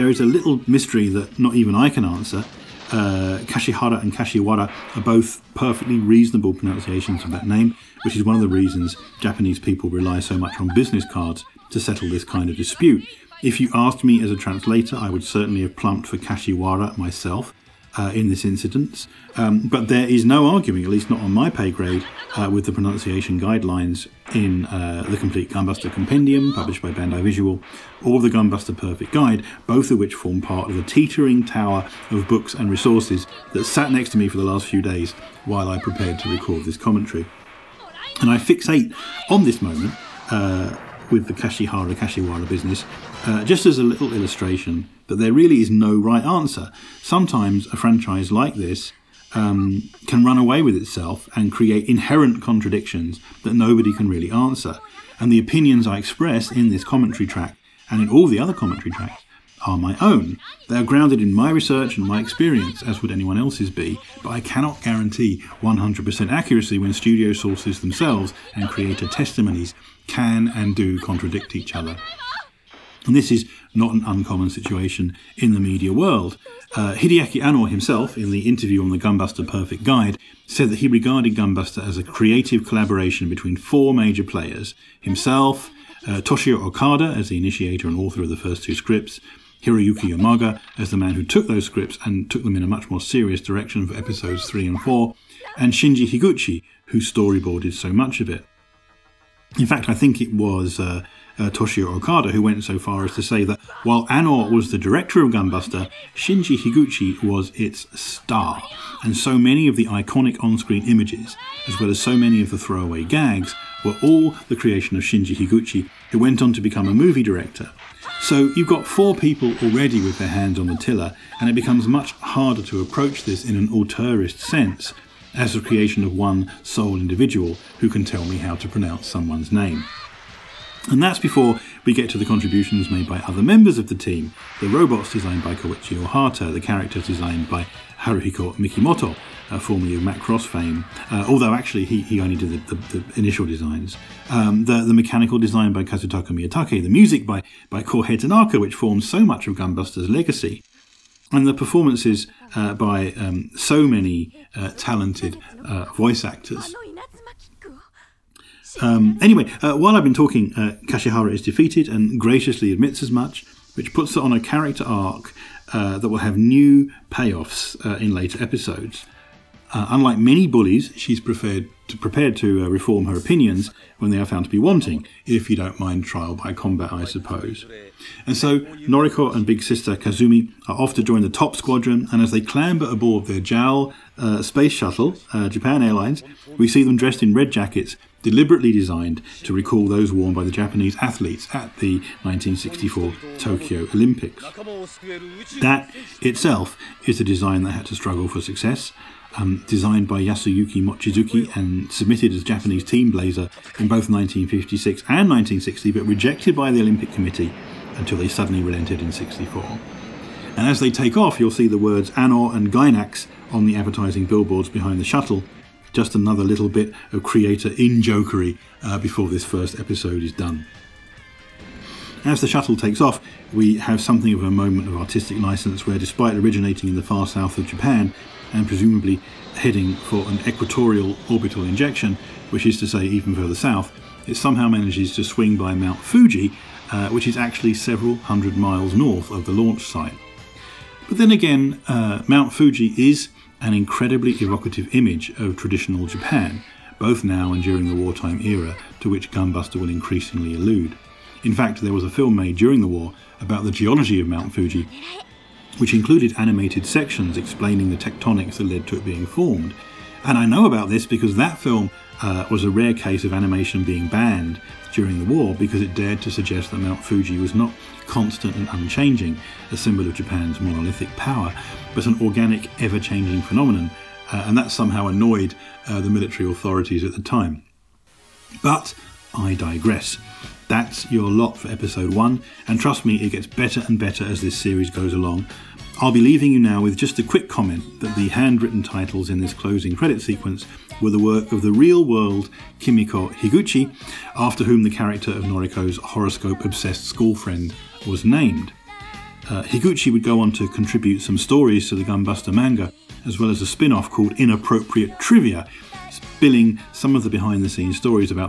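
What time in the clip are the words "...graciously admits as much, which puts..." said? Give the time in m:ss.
2:42.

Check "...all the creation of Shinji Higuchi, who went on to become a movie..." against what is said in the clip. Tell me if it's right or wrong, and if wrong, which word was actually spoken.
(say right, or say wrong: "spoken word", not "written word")
right.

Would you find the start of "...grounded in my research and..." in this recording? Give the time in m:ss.
1:00.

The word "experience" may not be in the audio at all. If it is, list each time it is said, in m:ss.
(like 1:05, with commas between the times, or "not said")
1:02.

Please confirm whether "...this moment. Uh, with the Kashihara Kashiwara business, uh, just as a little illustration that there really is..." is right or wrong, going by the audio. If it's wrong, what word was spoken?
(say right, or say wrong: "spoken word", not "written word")
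right.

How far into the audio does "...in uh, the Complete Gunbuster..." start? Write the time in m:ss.
0:24.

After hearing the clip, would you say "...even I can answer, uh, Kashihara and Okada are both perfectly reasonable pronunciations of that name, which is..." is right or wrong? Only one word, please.
wrong.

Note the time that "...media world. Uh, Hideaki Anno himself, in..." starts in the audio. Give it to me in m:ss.
1:15.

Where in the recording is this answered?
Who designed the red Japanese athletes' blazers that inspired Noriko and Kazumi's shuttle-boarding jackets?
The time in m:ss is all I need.
3:20.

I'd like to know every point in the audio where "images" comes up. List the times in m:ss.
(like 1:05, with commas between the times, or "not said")
1:50, 4:04.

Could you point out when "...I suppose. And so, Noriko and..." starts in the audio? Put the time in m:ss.
2:56.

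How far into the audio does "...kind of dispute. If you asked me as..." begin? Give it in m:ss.
0:12.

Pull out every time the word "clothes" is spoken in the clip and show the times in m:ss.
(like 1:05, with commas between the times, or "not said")
not said.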